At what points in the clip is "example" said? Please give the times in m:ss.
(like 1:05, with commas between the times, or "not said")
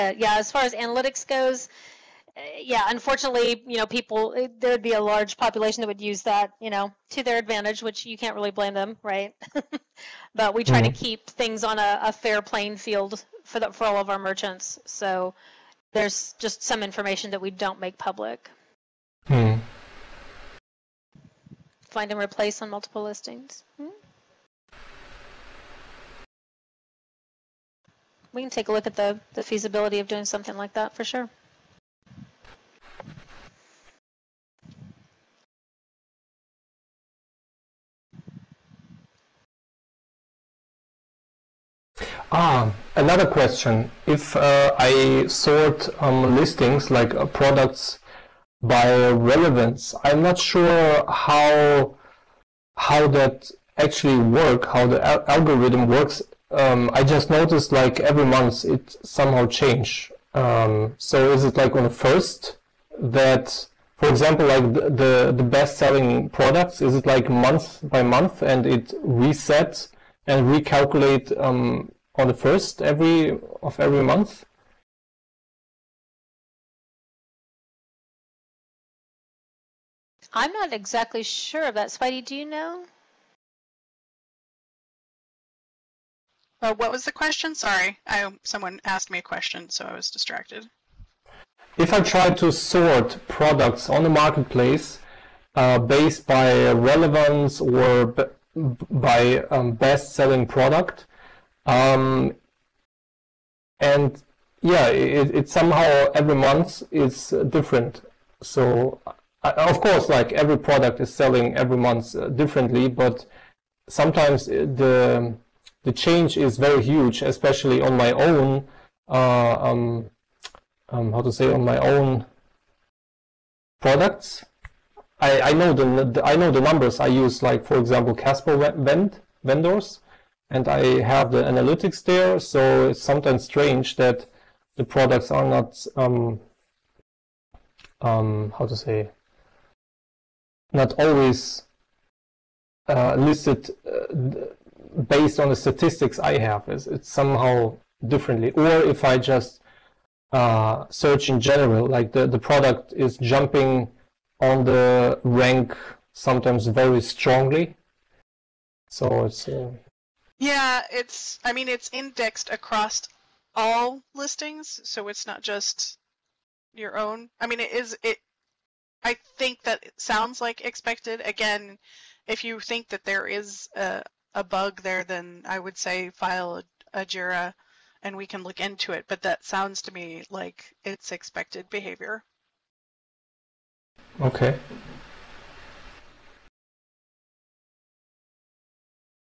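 1:04, 2:07.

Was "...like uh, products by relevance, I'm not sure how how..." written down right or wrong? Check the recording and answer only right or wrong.
right.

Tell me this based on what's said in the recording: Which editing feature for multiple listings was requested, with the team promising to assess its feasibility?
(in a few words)
Find and replace.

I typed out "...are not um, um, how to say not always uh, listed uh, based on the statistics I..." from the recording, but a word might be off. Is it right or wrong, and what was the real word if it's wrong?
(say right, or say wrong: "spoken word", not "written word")
right.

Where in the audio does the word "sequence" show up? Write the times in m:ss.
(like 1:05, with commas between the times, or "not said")
not said.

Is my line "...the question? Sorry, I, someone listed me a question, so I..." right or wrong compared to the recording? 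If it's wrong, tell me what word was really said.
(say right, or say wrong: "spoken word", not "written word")
wrong: "asked", not "listed".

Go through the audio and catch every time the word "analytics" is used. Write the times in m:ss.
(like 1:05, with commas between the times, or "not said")
0:00, 2:11.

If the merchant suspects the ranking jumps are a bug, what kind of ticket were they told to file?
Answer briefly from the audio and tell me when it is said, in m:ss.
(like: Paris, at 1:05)
JIRA, at 2:57.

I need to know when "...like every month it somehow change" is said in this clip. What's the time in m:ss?
0:57.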